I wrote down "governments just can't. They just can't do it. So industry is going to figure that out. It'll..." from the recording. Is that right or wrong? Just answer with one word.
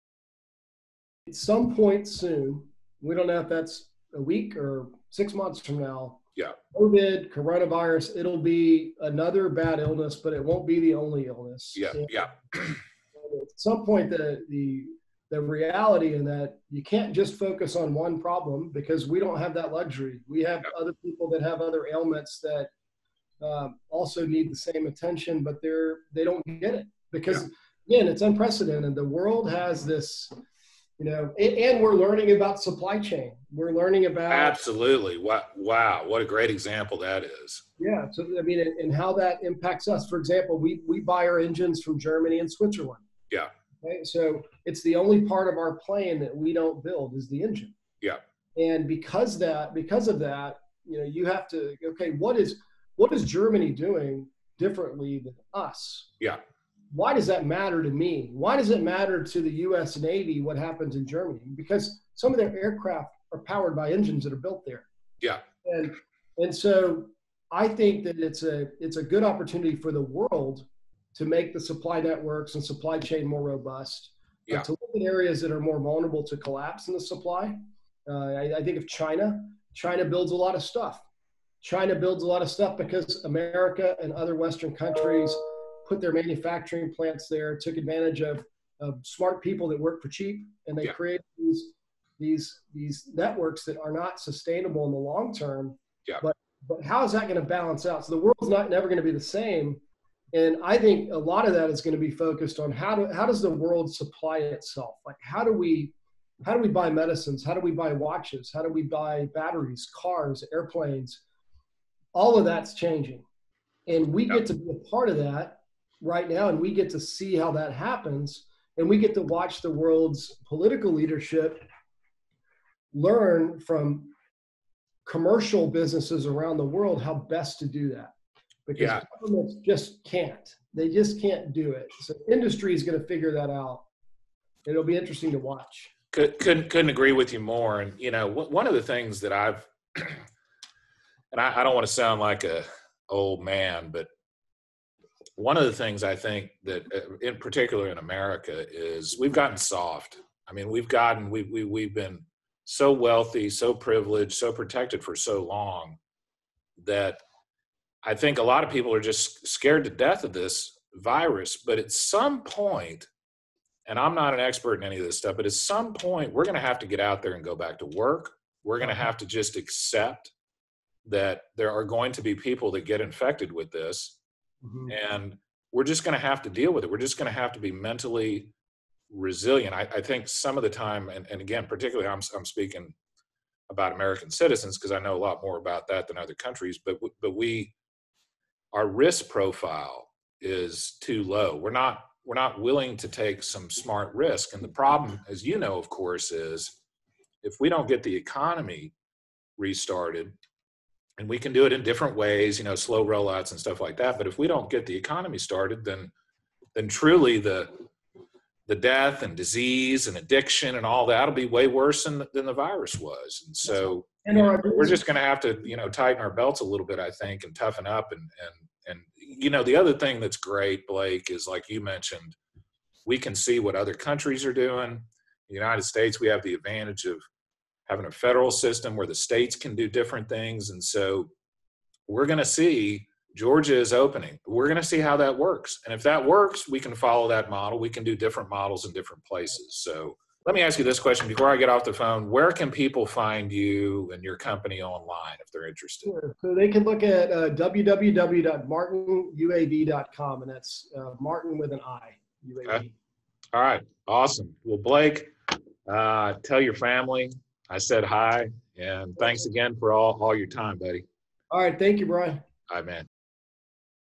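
right.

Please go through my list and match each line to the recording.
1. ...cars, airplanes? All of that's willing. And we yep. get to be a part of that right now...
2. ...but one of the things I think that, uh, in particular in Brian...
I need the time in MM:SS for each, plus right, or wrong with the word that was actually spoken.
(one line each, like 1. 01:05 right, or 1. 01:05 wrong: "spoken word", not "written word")
1. 01:49 wrong: "changing", not "willing"
2. 02:23 wrong: "America", not "Brian".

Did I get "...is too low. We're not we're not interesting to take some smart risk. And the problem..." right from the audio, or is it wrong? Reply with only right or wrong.
wrong.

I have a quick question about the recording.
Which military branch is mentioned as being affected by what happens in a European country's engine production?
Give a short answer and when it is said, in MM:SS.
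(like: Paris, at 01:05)
US Navy, at 00:59.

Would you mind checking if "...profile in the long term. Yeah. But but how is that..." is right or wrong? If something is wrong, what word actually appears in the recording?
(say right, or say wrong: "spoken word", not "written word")
wrong: "sustainable", not "profile".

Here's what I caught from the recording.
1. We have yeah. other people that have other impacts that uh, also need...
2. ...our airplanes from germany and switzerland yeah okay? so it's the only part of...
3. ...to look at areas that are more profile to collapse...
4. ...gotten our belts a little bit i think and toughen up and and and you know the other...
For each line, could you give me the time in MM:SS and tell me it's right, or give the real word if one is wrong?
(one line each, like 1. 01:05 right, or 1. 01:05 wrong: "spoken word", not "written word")
1. 00:20 wrong: "ailments", not "impacts"
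2. 00:41 wrong: "engines", not "airplanes"
3. 01:14 wrong: "vulnerable", not "profile"
4. 03:35 wrong: "tighten", not "gotten".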